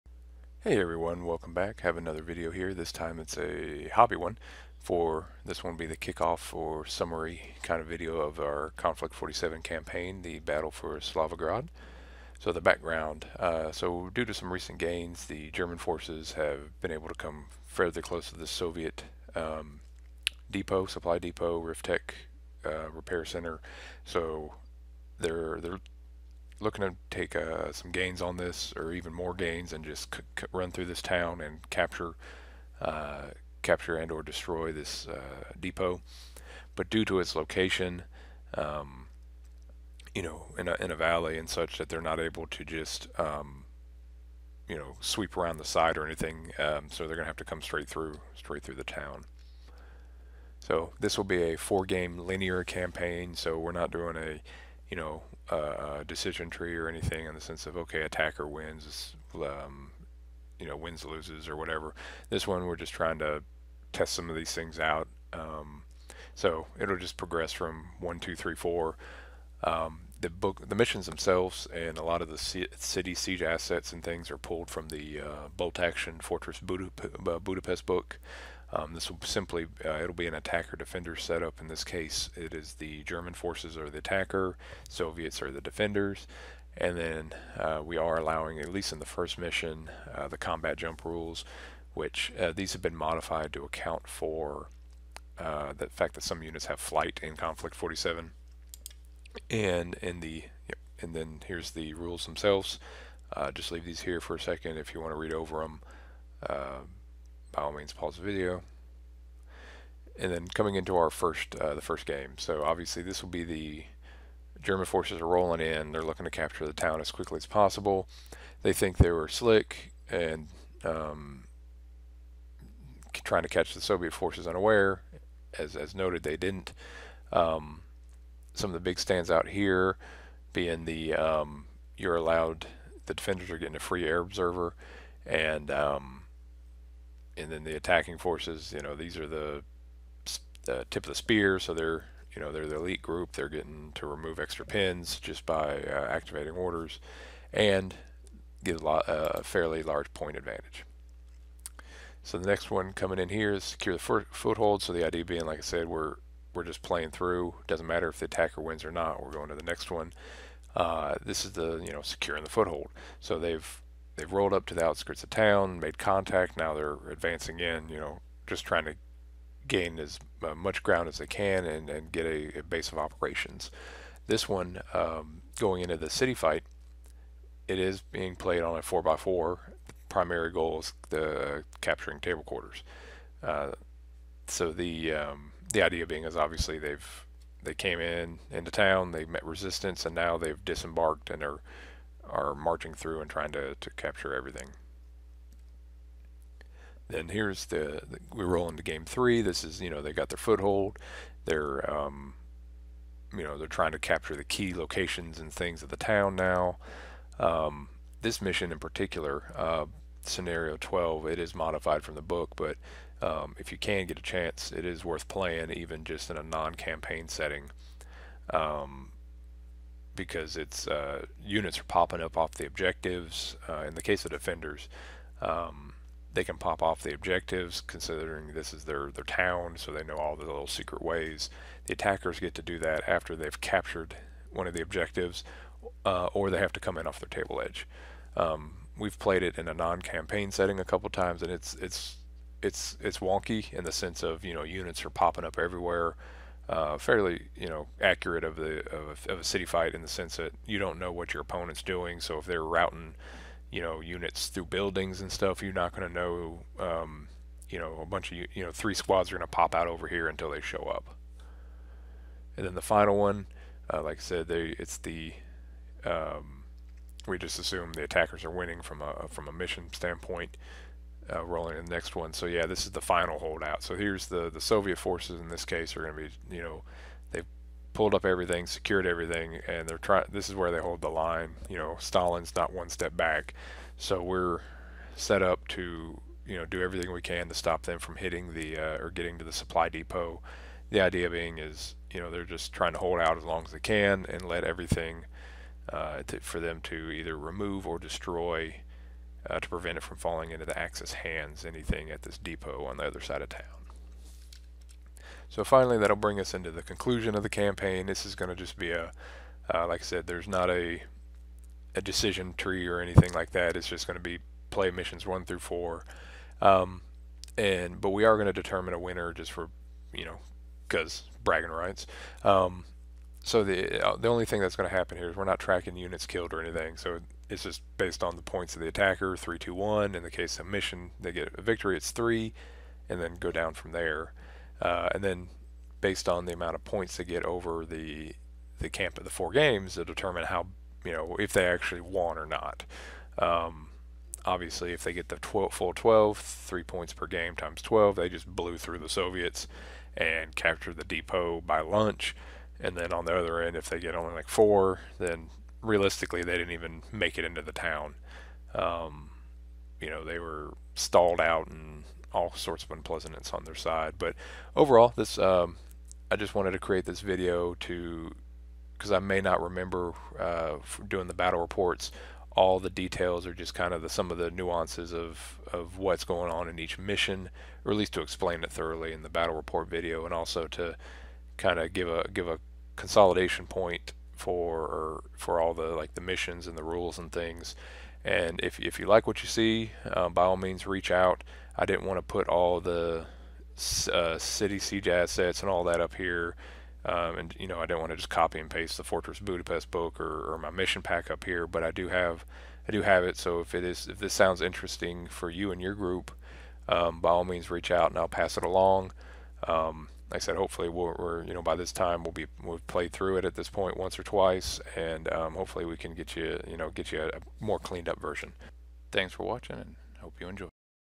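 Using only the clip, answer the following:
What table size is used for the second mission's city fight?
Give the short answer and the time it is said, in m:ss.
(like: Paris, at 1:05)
4x4, at 2:58.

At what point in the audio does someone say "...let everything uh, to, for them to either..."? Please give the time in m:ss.
4:54.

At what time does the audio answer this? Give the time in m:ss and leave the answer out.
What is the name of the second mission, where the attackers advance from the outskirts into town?
2:33.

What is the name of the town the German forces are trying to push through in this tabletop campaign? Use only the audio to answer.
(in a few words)
Solivgrad.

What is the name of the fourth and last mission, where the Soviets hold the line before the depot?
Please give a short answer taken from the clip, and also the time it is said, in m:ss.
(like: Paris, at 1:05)
The final holdout, at 4:32.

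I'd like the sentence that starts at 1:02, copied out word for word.
This one we're just trying to test some of these things out.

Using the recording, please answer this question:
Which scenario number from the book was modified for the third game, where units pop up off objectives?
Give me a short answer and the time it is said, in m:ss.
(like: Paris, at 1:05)
12, at 3:30.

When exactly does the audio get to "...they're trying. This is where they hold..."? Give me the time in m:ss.
4:39.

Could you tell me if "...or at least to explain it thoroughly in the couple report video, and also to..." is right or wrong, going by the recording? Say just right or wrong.
wrong.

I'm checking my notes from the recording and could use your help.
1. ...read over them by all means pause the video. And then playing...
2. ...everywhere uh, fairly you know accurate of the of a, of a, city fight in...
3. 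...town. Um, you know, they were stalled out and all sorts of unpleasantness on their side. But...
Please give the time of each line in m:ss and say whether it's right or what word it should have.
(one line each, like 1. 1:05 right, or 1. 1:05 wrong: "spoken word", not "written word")
1. 1:45 wrong: "coming", not "playing"
2. 4:05 right
3. 5:57 right.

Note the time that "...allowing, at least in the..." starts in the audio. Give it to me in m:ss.
1:28.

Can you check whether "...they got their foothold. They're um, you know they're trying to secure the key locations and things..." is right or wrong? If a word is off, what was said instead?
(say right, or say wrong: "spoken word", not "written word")
wrong: "capture", not "secure".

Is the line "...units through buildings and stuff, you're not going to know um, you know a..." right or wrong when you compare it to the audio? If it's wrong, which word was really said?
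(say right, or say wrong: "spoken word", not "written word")
right.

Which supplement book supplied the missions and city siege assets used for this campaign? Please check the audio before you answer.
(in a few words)
Fortress Budapest.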